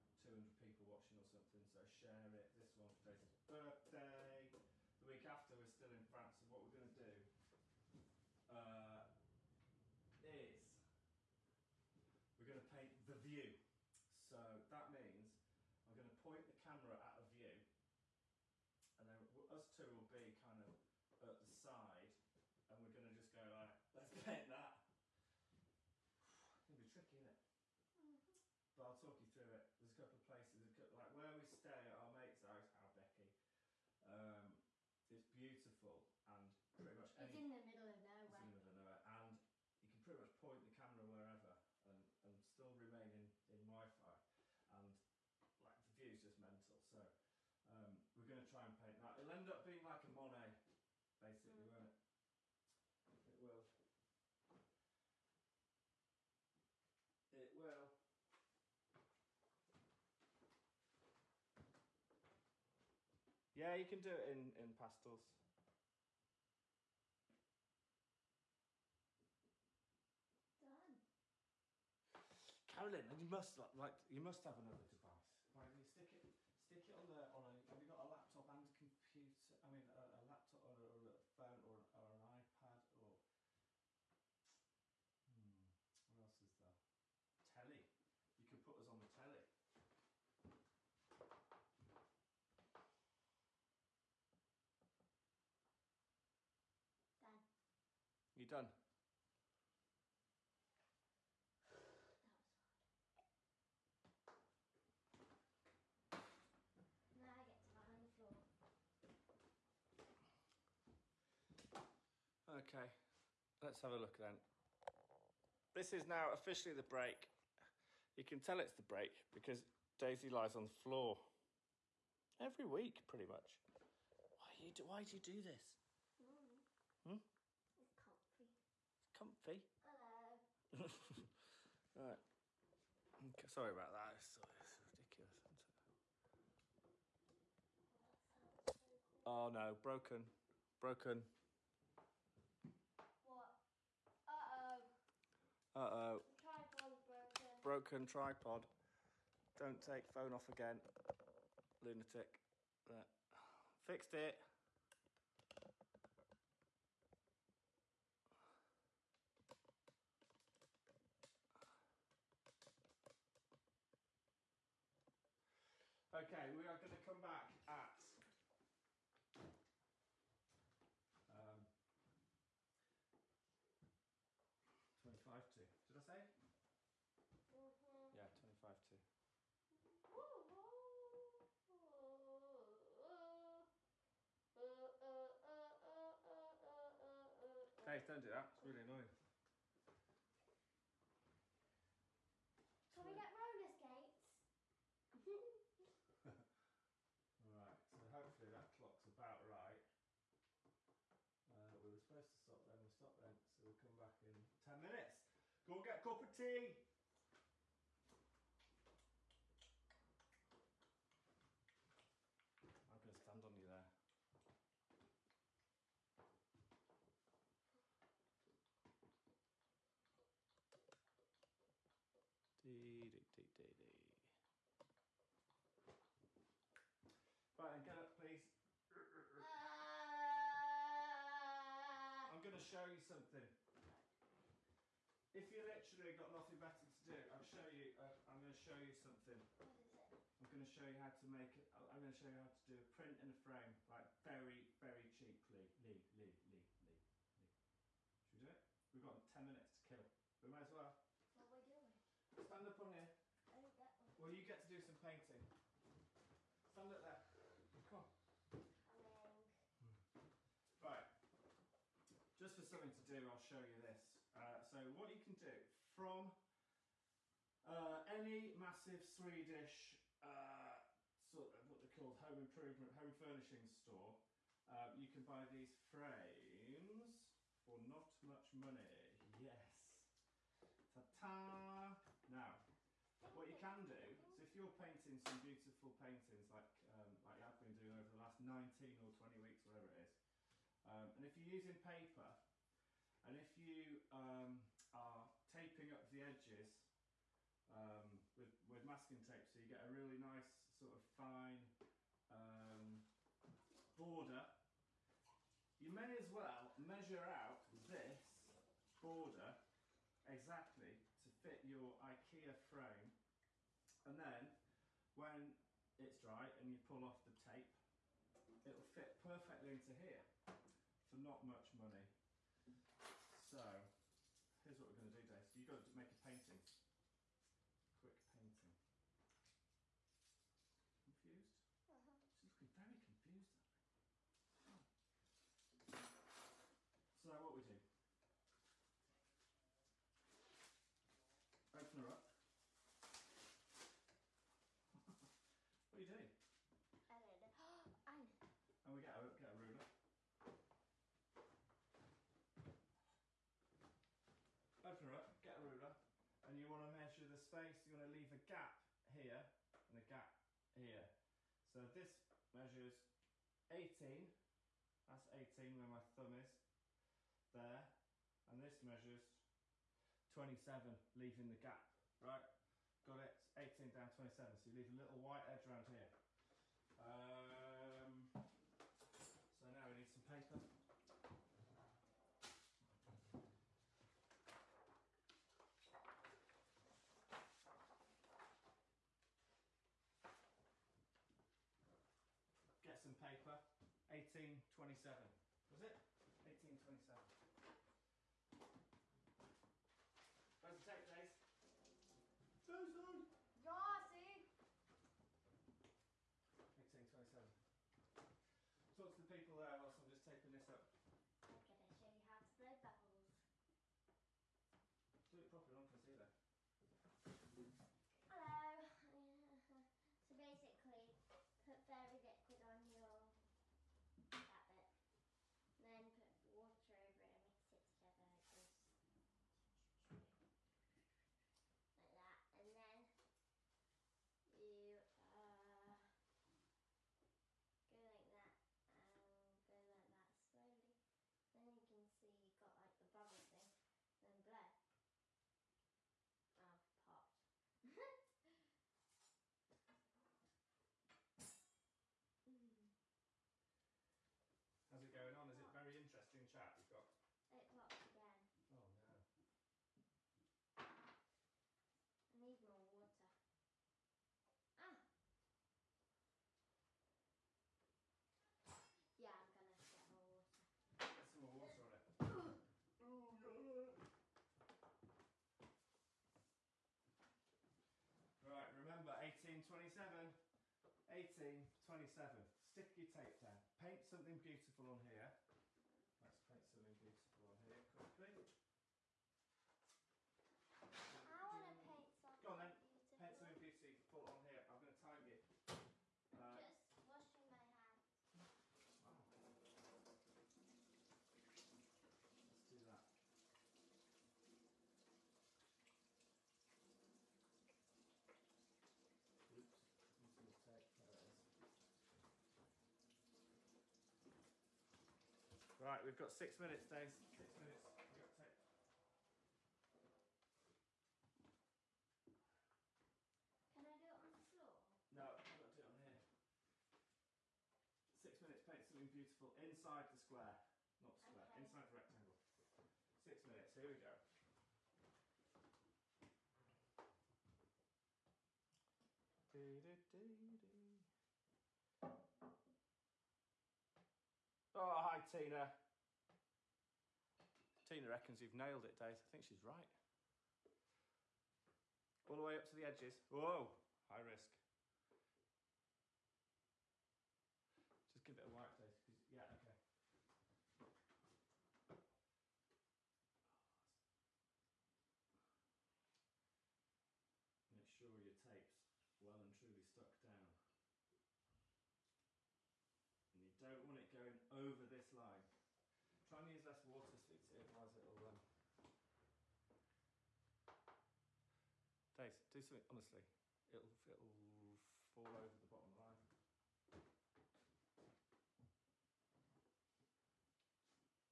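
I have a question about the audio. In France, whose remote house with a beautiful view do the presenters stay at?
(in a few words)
Becky.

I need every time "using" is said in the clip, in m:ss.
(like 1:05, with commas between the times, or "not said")
4:51.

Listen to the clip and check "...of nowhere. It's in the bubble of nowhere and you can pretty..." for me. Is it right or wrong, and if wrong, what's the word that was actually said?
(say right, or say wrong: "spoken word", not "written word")
wrong: "middle", not "bubble".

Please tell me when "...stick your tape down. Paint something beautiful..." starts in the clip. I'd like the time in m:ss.
8:02.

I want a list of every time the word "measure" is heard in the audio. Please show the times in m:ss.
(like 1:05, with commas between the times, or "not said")
5:06, 5:56, 6:02, 6:08.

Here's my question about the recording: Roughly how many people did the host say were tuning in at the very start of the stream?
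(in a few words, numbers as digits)
200.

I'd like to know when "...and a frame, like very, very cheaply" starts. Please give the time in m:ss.
4:03.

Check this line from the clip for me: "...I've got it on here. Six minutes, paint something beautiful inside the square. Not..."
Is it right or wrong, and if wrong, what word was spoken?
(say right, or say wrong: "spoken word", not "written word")
right.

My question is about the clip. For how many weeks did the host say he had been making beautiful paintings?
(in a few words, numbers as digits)
19 or 20.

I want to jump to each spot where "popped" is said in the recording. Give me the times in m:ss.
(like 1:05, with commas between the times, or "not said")
7:27, 7:37.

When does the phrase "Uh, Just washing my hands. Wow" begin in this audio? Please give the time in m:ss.
8:16.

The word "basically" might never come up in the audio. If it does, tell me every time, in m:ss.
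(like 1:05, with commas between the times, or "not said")
0:51, 7:00.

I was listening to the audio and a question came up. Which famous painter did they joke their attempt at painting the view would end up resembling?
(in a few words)
Monet.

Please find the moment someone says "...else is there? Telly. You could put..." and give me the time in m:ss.
1:26.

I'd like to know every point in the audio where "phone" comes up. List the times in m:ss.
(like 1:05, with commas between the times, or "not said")
1:21, 2:30.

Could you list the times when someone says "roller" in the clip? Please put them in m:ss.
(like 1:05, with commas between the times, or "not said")
3:13.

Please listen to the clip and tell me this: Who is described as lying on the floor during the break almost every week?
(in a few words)
Daisy.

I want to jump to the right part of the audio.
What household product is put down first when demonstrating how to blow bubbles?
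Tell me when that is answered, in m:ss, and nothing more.
7:01.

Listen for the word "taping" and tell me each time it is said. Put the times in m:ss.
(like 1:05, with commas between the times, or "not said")
4:55, 6:50.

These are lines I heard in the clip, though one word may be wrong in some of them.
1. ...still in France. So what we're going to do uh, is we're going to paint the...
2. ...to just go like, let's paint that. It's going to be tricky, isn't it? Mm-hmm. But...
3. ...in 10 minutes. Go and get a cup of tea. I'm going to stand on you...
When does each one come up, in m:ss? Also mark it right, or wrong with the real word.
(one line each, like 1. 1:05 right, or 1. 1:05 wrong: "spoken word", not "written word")
1. 0:05 right
2. 0:23 right
3. 3:24 right.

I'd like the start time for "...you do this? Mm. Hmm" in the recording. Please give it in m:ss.
2:05.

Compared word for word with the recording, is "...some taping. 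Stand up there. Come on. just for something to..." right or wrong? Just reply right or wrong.
wrong.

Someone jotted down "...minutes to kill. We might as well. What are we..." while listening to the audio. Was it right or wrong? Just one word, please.
right.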